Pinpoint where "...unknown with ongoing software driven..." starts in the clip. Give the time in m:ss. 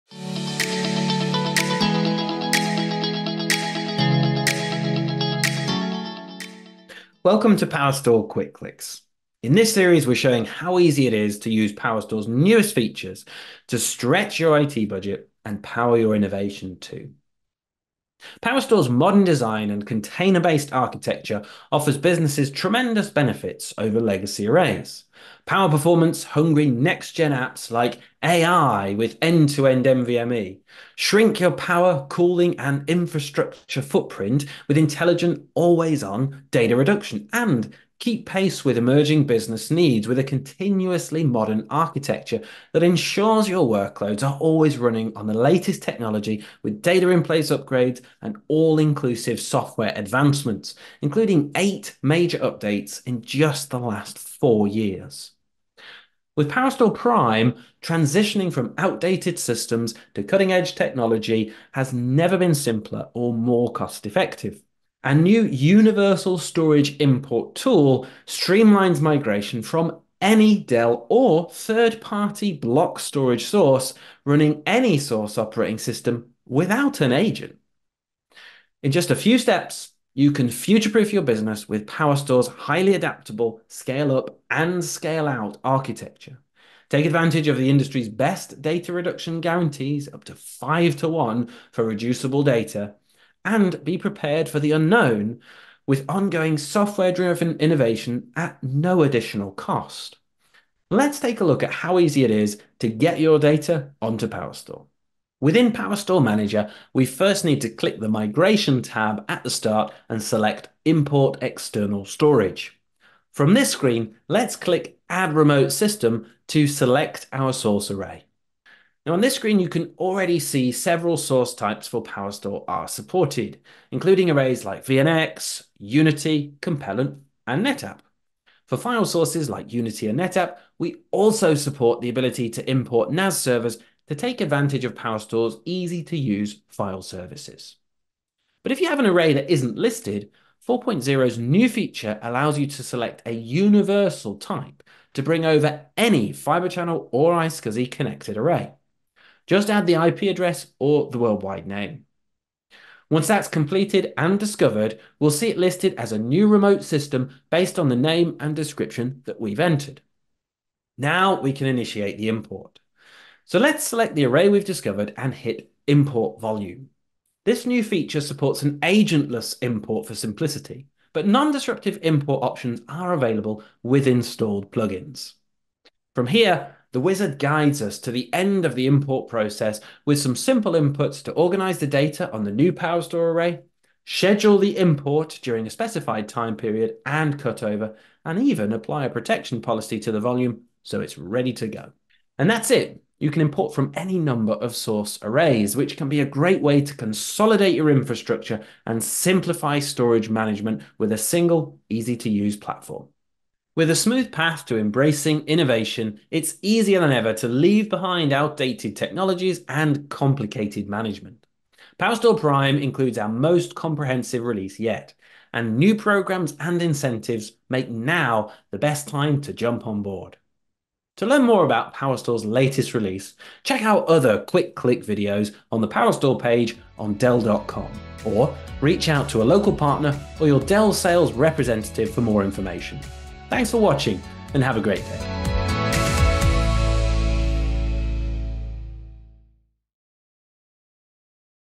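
1:34.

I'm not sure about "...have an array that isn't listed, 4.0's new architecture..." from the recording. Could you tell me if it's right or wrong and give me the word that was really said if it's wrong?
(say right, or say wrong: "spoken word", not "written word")
wrong: "feature", not "architecture".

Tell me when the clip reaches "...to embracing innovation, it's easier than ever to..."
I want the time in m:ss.
3:24.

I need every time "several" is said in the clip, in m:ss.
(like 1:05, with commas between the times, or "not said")
2:00.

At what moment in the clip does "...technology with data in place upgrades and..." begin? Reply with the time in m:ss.
0:45.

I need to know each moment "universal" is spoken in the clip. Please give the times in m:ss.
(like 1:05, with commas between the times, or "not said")
1:05, 2:23.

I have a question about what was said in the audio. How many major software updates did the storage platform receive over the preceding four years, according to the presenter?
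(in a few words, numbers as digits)
8.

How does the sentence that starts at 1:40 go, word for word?
Let's take a look at how easy it is to get your data onto PowerStore.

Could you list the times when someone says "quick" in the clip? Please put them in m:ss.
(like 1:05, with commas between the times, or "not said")
0:08, 3:44.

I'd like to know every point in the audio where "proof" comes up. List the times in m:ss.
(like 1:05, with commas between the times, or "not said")
1:20.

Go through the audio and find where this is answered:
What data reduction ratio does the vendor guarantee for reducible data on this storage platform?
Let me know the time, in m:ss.
1:30.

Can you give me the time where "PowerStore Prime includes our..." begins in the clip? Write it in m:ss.
3:31.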